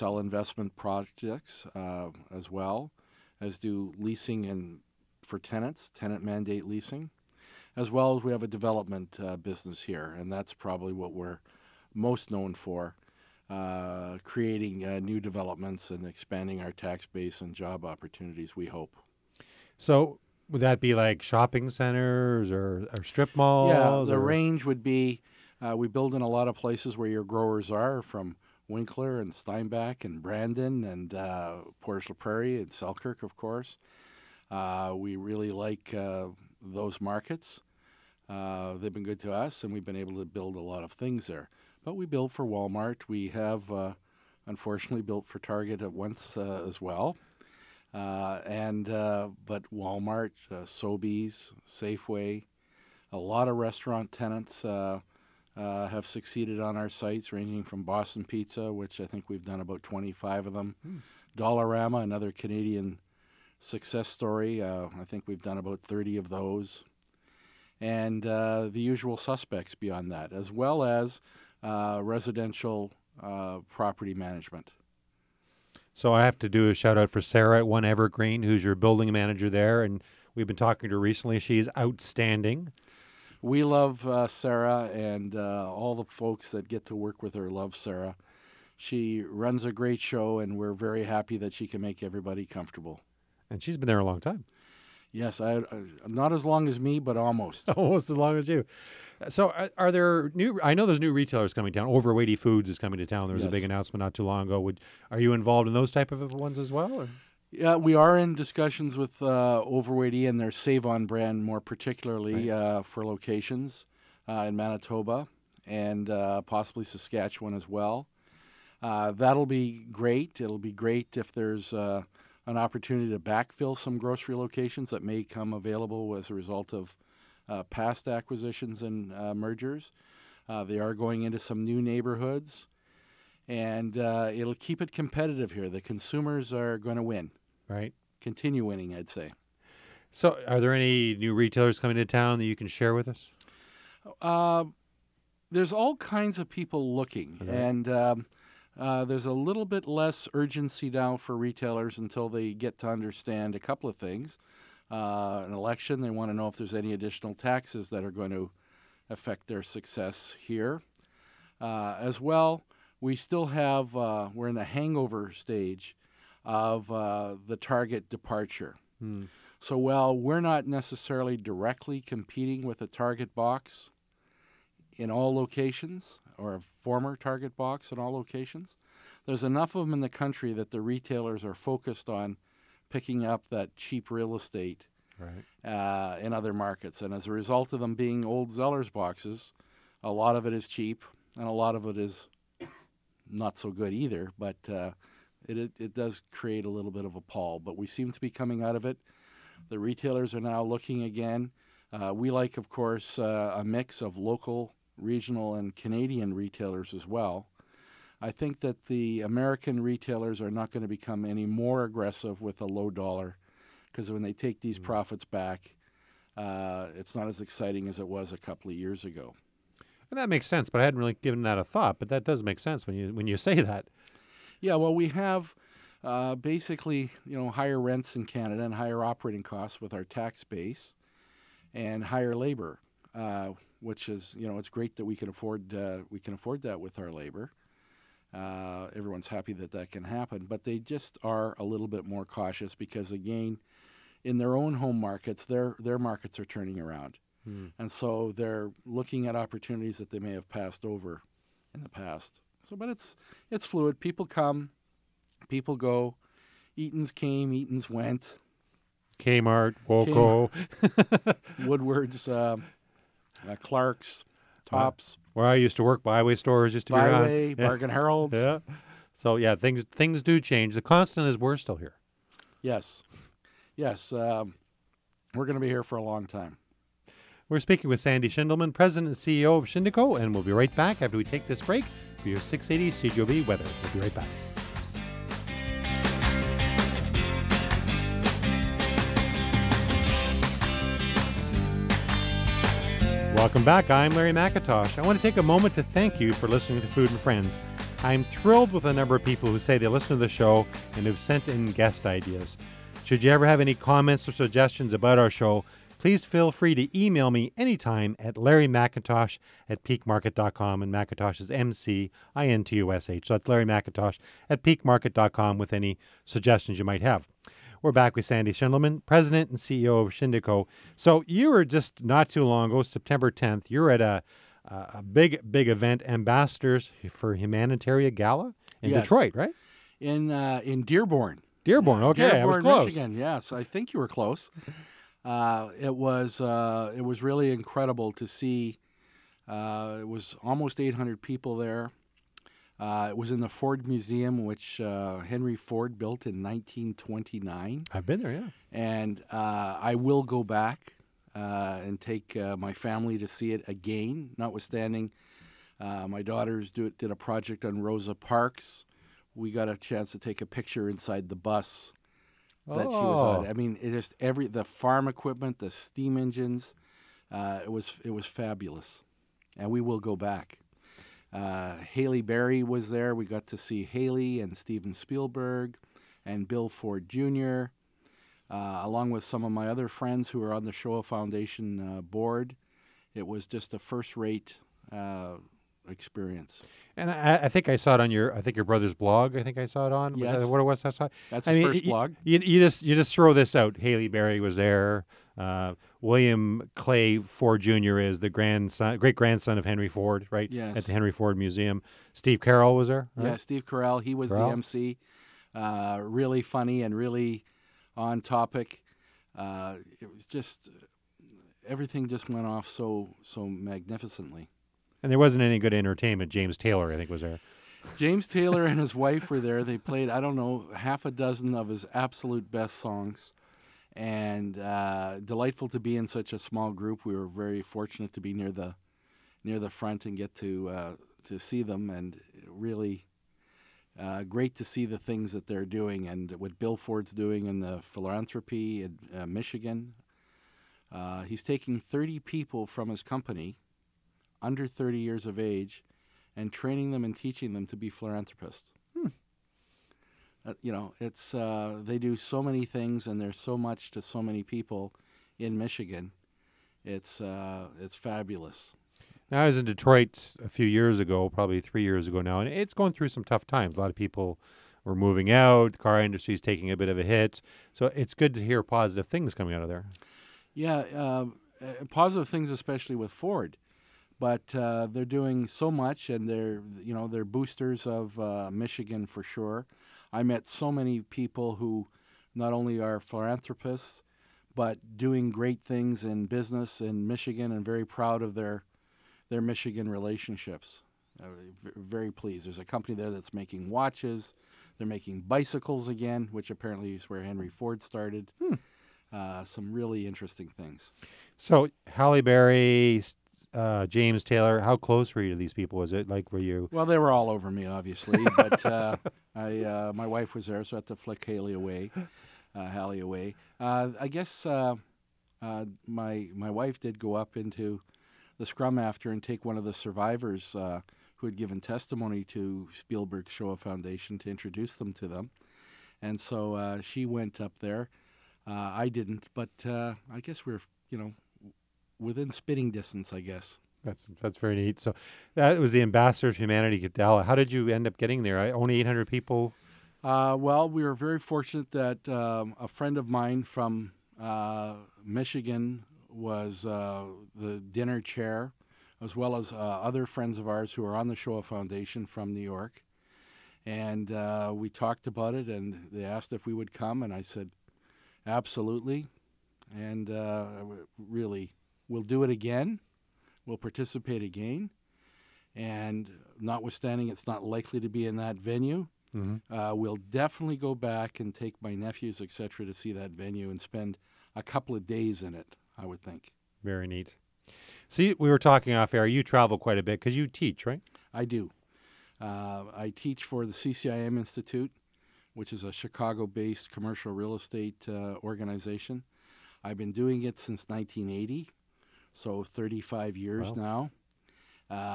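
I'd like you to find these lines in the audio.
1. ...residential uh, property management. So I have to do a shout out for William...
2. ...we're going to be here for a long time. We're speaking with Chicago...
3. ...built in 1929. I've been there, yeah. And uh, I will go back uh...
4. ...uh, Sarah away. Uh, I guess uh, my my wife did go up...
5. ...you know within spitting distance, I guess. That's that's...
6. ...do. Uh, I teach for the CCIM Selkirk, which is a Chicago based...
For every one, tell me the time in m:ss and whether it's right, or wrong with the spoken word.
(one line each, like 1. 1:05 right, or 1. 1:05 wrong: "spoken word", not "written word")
1. 1:12 wrong: "Sarah", not "William"
2. 4:35 wrong: "Sandy", not "Chicago"
3. 5:45 right
4. 8:32 wrong: "Hallie", not "Sarah"
5. 8:50 right
6. 9:41 wrong: "Institute", not "Selkirk".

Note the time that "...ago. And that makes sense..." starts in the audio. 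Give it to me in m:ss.
3:39.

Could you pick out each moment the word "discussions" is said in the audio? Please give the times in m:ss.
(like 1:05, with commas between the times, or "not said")
1:48.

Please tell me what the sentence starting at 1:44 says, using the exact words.
Would are you involved in those type of ones as well?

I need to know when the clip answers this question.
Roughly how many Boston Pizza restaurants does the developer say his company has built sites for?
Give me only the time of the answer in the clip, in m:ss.
0:59.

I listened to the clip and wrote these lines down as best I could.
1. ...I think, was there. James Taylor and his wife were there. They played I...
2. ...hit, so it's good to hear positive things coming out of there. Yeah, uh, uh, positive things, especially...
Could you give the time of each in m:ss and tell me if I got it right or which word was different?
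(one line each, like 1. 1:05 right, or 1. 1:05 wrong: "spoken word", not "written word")
1. 6:56 right
2. 7:47 right.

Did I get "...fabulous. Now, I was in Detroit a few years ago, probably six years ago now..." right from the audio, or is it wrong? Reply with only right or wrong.
wrong.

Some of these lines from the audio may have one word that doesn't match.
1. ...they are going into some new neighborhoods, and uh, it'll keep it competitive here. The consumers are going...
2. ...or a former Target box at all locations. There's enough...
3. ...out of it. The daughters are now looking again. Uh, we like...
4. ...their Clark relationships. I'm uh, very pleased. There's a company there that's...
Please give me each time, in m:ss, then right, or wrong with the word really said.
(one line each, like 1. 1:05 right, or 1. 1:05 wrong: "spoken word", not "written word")
1. 2:10 right
2. 2:56 right
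3. 3:18 wrong: "retailers", not "daughters"
4. 8:09 wrong: "Michigan", not "Clark".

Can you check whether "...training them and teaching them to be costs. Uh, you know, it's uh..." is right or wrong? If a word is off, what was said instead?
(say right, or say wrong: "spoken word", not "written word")
wrong: "philanthropists", not "costs".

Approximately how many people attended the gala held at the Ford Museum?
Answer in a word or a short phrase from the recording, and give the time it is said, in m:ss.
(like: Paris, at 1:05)
800, at 5:40.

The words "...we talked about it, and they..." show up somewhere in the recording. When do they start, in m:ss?
9:14.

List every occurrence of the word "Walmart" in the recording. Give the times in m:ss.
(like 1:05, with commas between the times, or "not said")
0:42, 0:49.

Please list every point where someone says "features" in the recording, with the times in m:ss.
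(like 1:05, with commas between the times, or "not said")
not said.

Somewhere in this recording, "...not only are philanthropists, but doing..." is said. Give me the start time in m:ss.
8:02.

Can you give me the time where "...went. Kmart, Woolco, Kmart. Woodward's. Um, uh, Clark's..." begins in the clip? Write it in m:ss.
4:17.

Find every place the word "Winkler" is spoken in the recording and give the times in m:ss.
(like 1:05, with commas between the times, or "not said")
0:28.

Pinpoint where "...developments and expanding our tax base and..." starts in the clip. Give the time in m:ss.
0:15.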